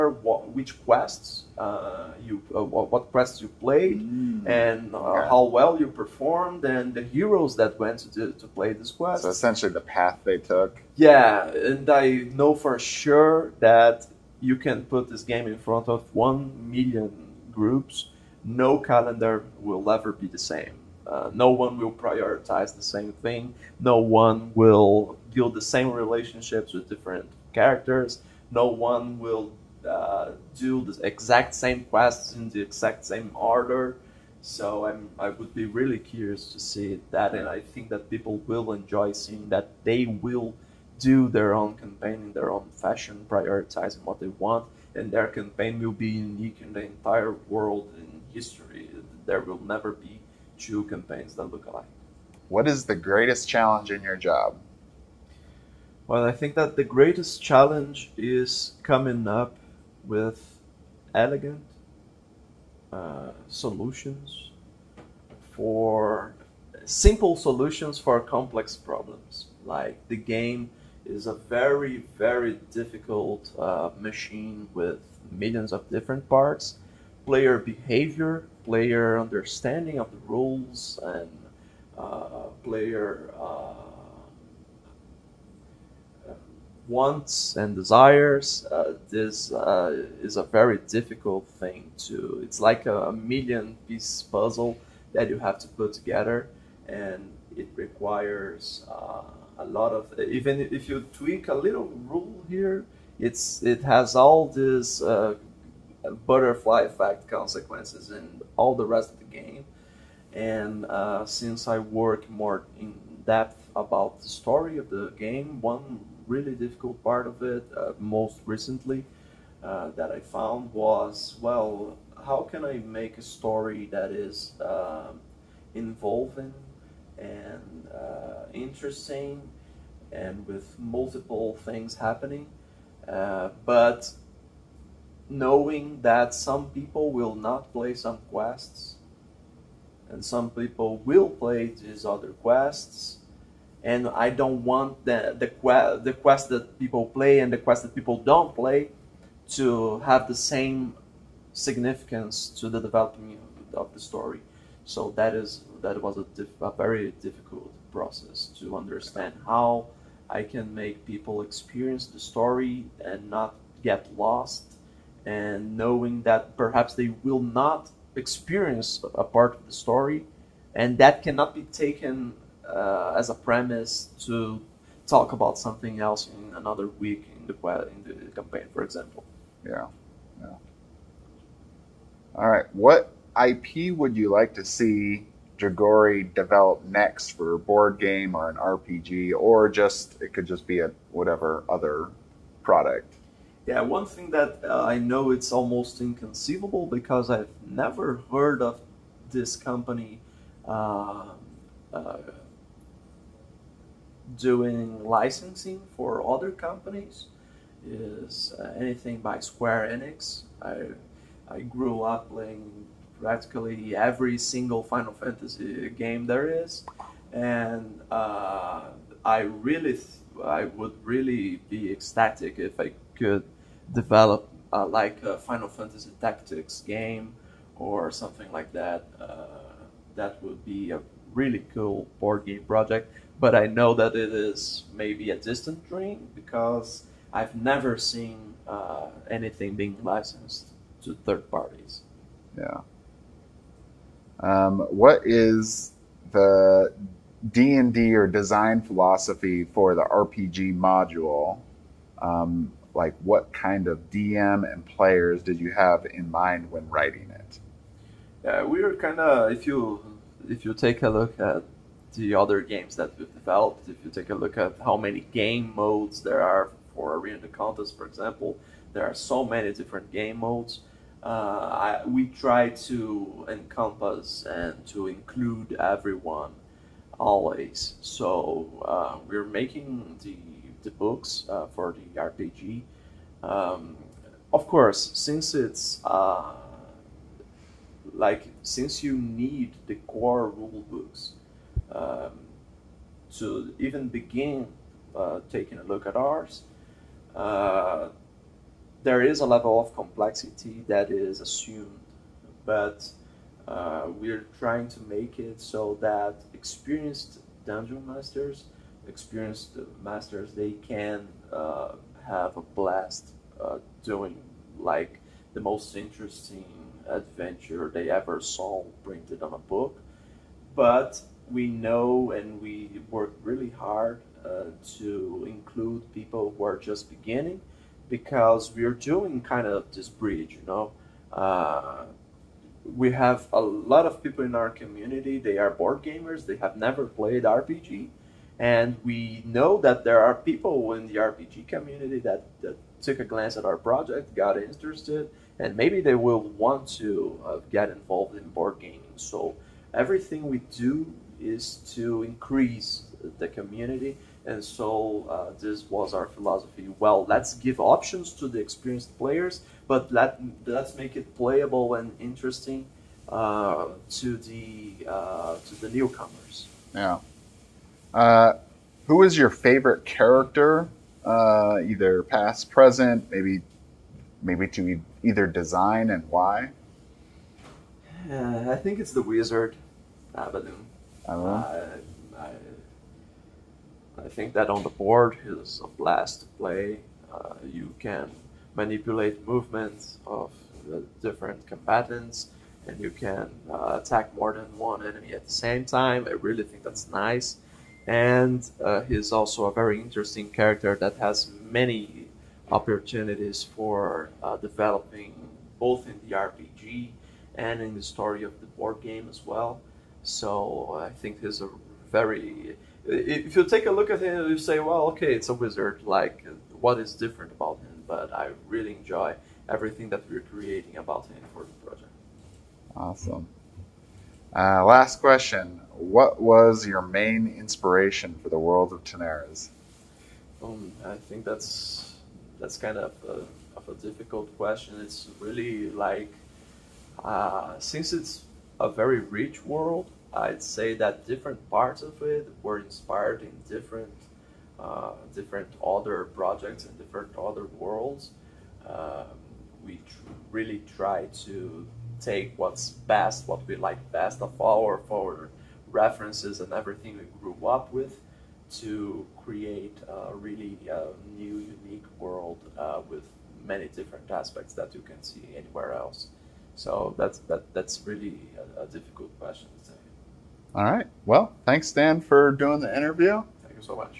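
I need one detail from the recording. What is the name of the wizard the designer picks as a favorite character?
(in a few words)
Abaddon.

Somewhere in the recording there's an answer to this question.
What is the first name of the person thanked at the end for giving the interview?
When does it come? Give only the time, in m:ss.
7:51.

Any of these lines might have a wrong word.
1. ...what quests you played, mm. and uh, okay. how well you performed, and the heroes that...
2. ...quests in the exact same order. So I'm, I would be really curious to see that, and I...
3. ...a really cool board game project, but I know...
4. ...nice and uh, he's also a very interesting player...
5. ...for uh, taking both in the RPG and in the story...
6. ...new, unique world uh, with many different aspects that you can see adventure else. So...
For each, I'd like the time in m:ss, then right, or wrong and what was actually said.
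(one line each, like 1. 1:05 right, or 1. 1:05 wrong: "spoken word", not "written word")
1. 0:02 right
2. 0:31 right
3. 3:50 right
4. 6:37 wrong: "character", not "player"
5. 6:43 wrong: "developing", not "taking"
6. 7:41 wrong: "anywhere", not "adventure".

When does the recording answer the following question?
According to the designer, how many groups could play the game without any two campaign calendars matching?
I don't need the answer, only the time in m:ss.
0:16.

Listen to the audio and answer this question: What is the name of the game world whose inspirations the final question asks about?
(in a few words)
Tanares.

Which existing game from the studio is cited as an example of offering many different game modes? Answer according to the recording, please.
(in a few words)
Arena Contest.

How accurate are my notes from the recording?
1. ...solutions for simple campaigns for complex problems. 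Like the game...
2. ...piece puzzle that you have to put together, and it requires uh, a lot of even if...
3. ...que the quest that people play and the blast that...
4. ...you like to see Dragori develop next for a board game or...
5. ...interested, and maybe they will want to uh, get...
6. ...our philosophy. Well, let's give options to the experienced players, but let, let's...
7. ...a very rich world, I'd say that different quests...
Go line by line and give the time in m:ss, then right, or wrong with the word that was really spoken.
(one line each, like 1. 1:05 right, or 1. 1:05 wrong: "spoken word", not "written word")
1. 1:03 wrong: "solutions", not "campaigns"
2. 1:33 right
3. 2:25 wrong: "quest", not "blast"
4. 3:04 right
5. 5:44 right
6. 5:56 right
7. 7:18 wrong: "parts", not "quests".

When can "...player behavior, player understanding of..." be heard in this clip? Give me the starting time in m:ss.
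1:17.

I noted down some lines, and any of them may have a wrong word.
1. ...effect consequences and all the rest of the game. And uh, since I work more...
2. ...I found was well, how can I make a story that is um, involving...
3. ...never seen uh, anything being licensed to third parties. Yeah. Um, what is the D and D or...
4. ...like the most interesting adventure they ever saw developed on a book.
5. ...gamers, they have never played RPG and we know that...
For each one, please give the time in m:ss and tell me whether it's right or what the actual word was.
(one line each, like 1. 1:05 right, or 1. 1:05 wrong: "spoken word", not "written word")
1. 1:46 right
2. 2:00 right
3. 3:57 right
4. 5:14 wrong: "printed", not "developed"
5. 5:36 right.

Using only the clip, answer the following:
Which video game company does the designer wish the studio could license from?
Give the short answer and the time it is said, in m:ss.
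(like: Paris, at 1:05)
Square Enix, at 3:29.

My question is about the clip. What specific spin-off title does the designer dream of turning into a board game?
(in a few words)
Final Fantasy Tactics.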